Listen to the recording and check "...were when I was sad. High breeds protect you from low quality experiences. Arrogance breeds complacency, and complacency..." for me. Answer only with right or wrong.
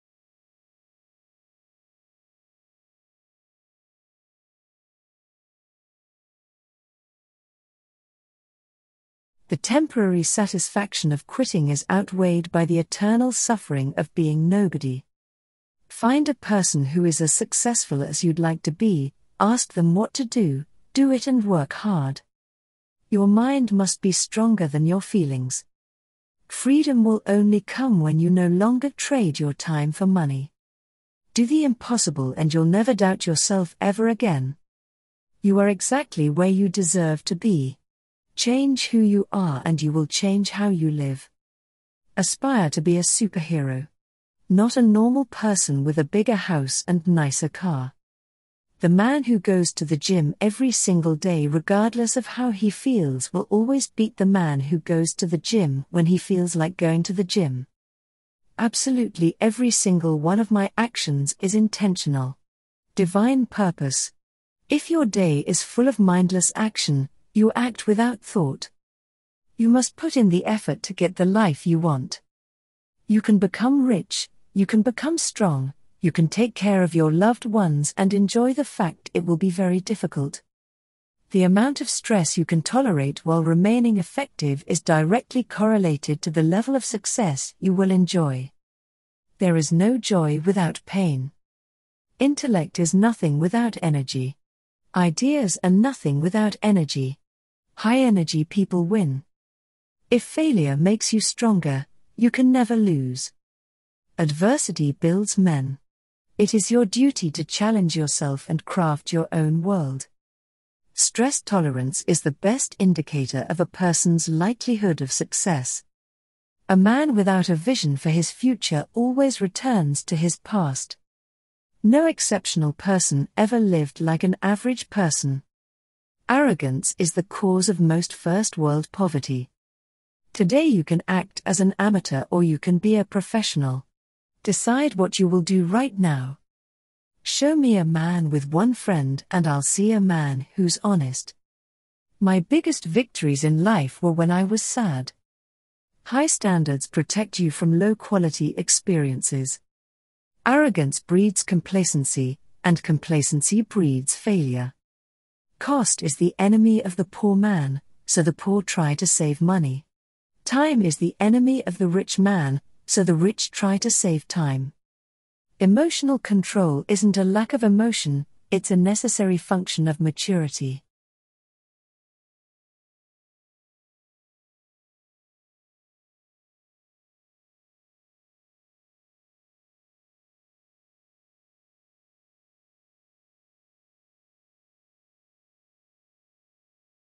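wrong.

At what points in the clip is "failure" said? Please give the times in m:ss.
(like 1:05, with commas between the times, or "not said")
1:40, 2:34.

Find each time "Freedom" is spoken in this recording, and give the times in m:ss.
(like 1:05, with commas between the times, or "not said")
0:26.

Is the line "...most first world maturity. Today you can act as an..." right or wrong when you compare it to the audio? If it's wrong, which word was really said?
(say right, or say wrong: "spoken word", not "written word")
wrong: "poverty", not "maturity".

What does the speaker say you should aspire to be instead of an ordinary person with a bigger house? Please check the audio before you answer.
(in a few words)
A superhero.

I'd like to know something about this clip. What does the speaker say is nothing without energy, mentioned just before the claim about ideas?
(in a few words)
Intellect.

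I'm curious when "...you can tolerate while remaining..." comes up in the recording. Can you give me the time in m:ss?
1:22.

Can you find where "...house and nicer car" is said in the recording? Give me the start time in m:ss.
0:46.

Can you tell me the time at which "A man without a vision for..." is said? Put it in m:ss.
1:56.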